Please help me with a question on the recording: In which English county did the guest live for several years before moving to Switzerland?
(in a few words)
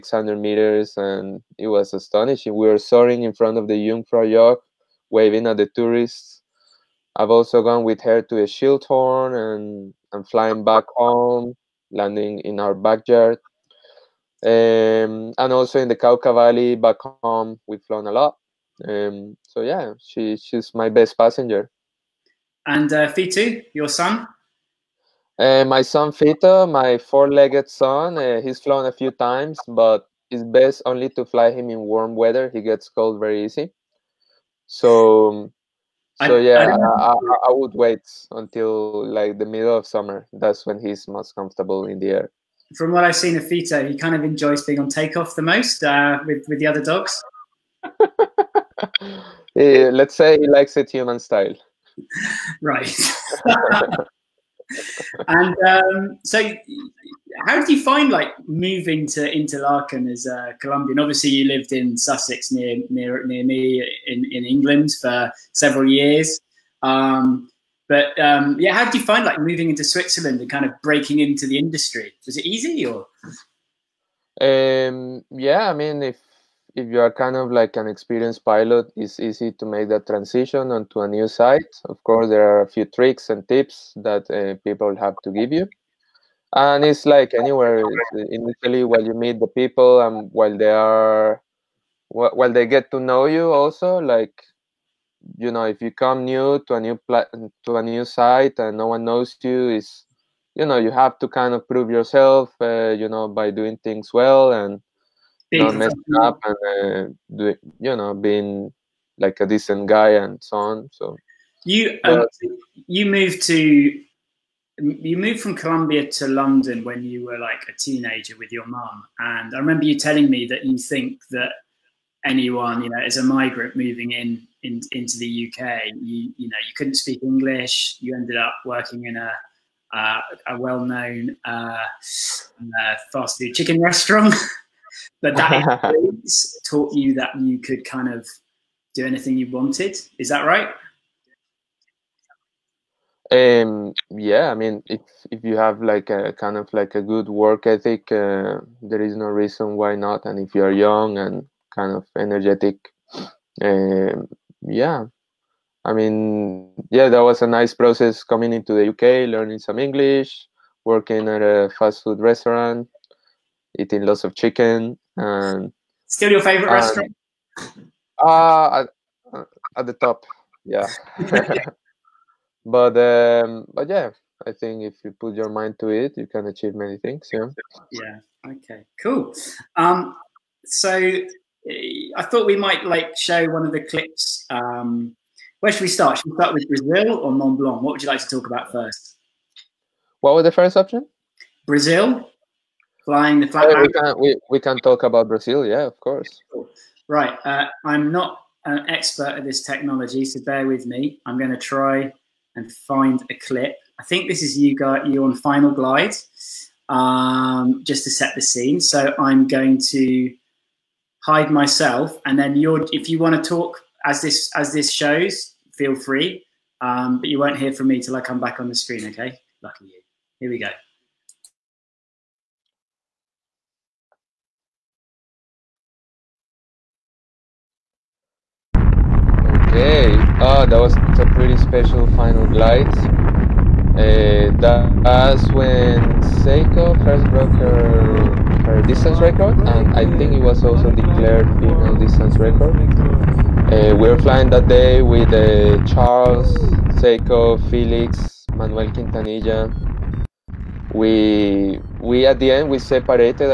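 Sussex.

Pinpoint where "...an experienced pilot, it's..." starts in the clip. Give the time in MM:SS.
01:17.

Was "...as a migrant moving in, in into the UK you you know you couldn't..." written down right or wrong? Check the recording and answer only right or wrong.
right.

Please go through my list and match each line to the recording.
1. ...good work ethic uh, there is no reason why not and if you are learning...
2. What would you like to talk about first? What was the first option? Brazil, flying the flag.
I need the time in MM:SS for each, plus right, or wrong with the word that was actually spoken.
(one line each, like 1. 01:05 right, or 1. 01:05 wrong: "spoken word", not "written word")
1. 02:27 wrong: "young", not "learning"
2. 03:07 right.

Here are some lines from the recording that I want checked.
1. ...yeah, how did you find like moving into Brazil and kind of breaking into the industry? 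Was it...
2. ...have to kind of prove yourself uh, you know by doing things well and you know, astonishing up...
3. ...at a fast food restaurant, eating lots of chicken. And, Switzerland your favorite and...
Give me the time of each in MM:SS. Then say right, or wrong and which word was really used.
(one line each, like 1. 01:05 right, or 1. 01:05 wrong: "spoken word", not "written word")
1. 01:08 wrong: "Switzerland", not "Brazil"
2. 01:40 wrong: "messing", not "astonishing"
3. 02:41 wrong: "Still", not "Switzerland".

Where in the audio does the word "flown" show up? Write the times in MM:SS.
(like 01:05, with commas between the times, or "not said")
00:17, 00:28.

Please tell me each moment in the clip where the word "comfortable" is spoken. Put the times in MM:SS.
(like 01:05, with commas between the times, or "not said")
00:41.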